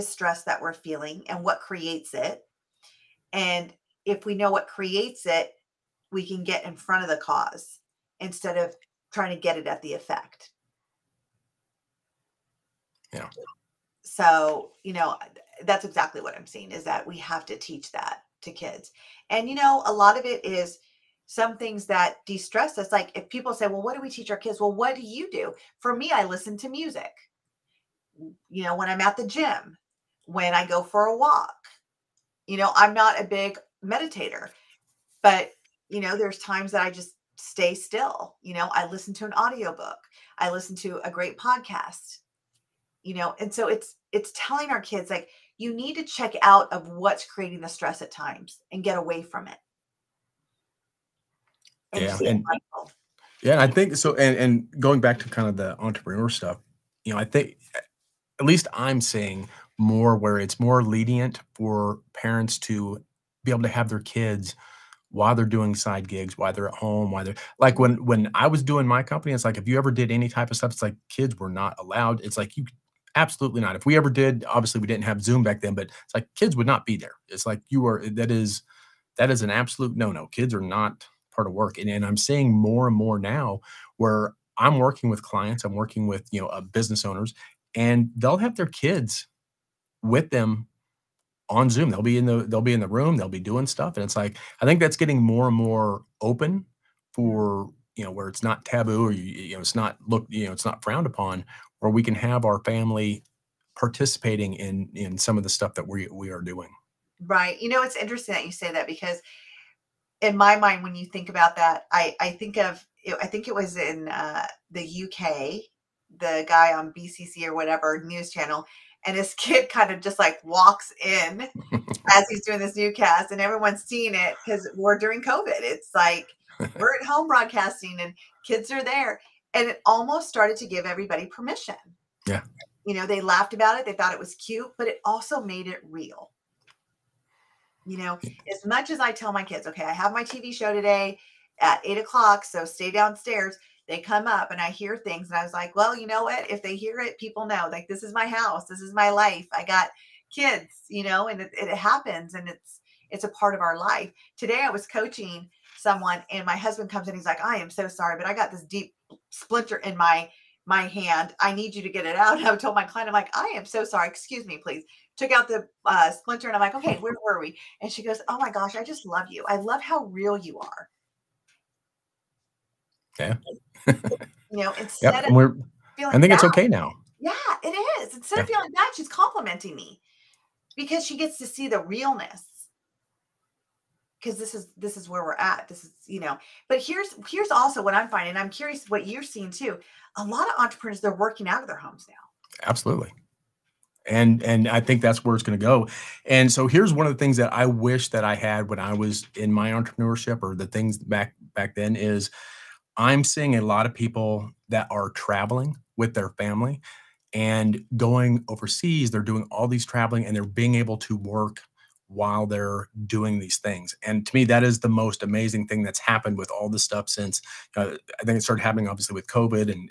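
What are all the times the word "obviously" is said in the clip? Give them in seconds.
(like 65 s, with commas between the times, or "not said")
74 s, 218 s.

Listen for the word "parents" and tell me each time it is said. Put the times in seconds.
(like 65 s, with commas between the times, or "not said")
62 s.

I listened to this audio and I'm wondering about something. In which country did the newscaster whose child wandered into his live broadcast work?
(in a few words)
UK.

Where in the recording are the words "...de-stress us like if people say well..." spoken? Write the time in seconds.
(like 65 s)
22 s.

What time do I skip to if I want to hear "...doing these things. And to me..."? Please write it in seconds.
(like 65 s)
213 s.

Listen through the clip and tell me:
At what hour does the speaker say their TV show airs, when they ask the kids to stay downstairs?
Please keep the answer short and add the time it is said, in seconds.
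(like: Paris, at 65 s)
8 o'clock, at 141 s.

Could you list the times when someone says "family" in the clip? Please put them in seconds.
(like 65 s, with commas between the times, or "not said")
102 s, 206 s.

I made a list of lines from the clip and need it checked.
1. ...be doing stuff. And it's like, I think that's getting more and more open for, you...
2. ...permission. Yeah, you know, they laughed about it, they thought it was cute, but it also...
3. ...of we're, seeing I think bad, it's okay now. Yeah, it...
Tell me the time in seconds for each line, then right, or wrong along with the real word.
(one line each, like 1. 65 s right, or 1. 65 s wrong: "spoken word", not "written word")
1. 93 s right
2. 131 s right
3. 175 s wrong: "feeling", not "seeing".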